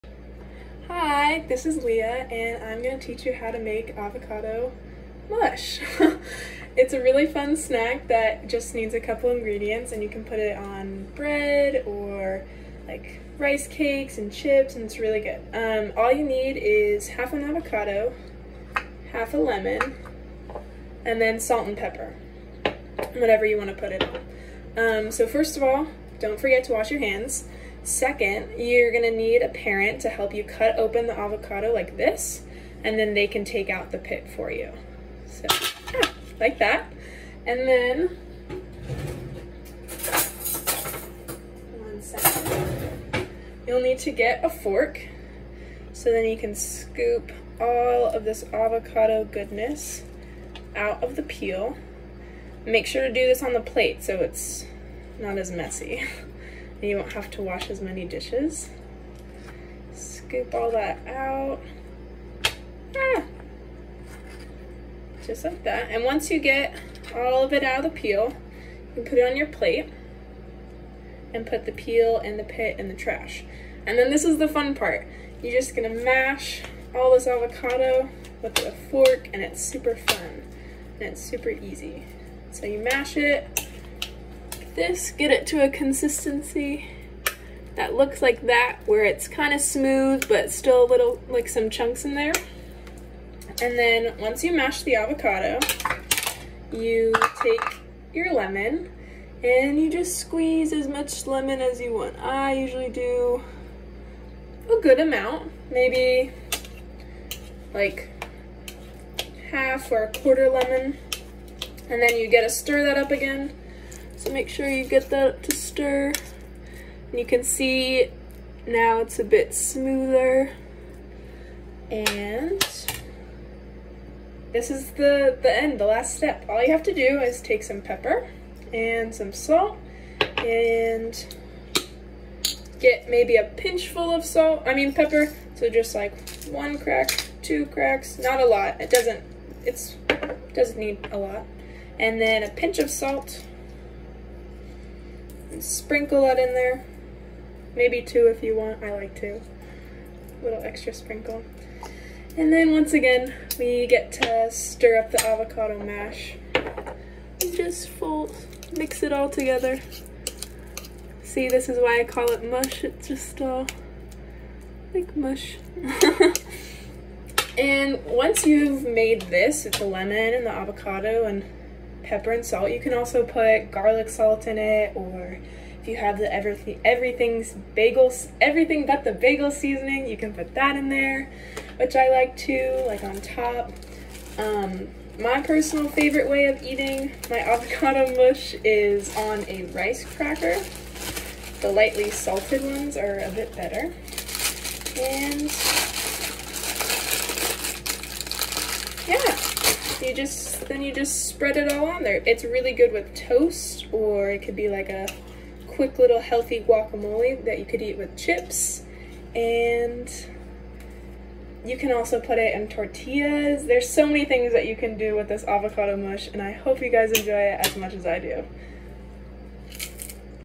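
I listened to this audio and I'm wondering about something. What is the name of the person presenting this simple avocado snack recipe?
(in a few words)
Leah.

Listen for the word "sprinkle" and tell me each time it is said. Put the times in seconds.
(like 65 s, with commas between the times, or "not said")
145 s, 150 s.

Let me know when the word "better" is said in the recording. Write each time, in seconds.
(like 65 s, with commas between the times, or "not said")
193 s.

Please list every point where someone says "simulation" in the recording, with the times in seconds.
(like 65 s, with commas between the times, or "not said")
not said.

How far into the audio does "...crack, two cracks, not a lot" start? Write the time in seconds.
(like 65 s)
136 s.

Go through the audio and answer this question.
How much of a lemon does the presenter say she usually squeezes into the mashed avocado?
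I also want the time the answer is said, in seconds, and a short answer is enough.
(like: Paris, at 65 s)
half or a quarter lemon, at 109 s.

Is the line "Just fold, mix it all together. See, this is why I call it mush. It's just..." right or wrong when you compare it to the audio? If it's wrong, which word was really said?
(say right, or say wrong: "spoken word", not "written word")
right.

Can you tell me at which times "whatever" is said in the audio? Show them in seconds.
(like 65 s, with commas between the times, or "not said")
23 s.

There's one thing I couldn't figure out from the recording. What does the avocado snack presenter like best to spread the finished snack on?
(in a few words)
rice cracker.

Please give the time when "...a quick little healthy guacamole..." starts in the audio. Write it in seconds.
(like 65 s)
204 s.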